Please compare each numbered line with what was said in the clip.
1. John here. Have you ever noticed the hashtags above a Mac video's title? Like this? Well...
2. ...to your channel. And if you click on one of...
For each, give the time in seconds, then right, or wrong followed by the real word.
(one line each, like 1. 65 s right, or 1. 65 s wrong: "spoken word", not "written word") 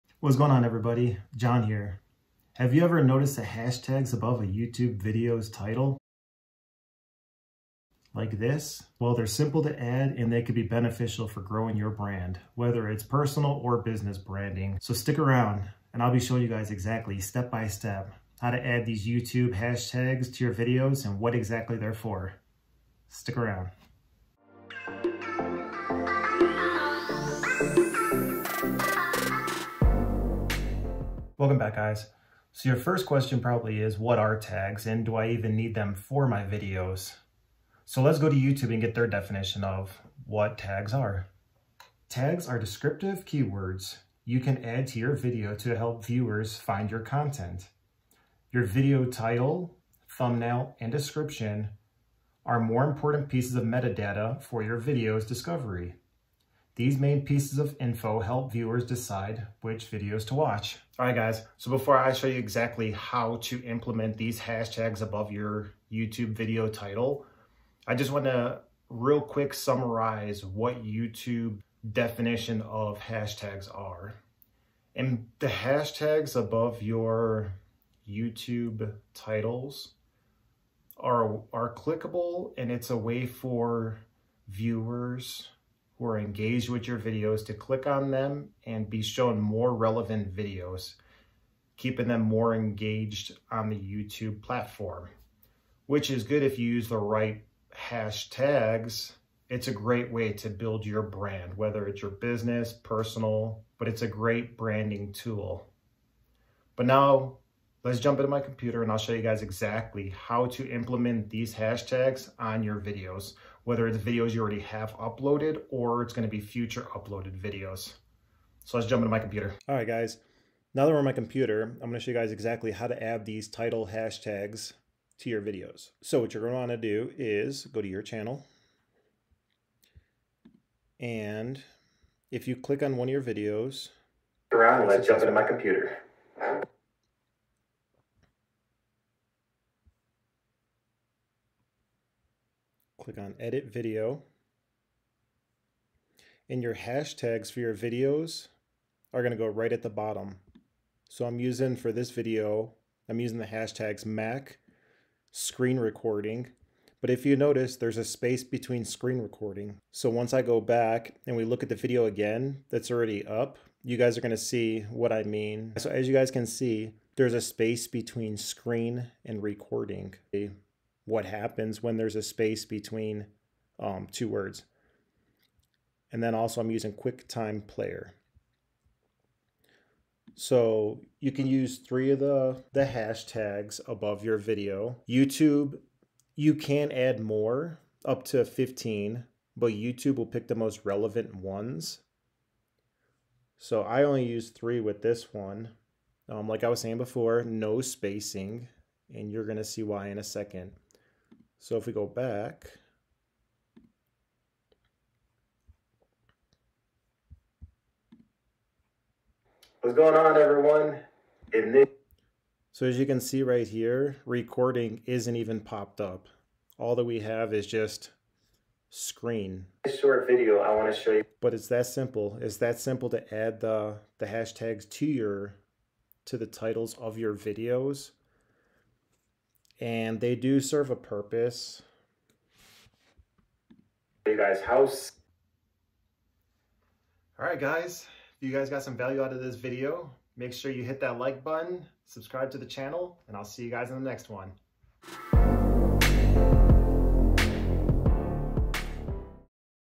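1. 1 s wrong: "YouTube", not "Mac"
2. 127 s right.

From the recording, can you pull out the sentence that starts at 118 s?
So let's jump into my computer.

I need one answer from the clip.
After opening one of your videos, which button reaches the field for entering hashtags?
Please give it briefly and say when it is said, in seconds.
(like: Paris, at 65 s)
Edit Video, at 143 s.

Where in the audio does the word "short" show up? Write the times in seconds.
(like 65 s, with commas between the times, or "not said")
219 s.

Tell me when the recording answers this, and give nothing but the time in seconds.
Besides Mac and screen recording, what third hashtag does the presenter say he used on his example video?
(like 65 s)
176 s.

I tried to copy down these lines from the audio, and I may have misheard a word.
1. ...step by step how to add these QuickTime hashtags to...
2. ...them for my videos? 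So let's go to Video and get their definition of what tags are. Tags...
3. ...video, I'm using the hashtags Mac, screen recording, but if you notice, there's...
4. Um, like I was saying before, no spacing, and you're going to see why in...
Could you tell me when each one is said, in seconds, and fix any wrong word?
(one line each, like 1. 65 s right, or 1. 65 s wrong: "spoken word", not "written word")
1. 17 s wrong: "YouTube", not "QuickTime"
2. 35 s wrong: "YouTube", not "Video"
3. 152 s right
4. 196 s right.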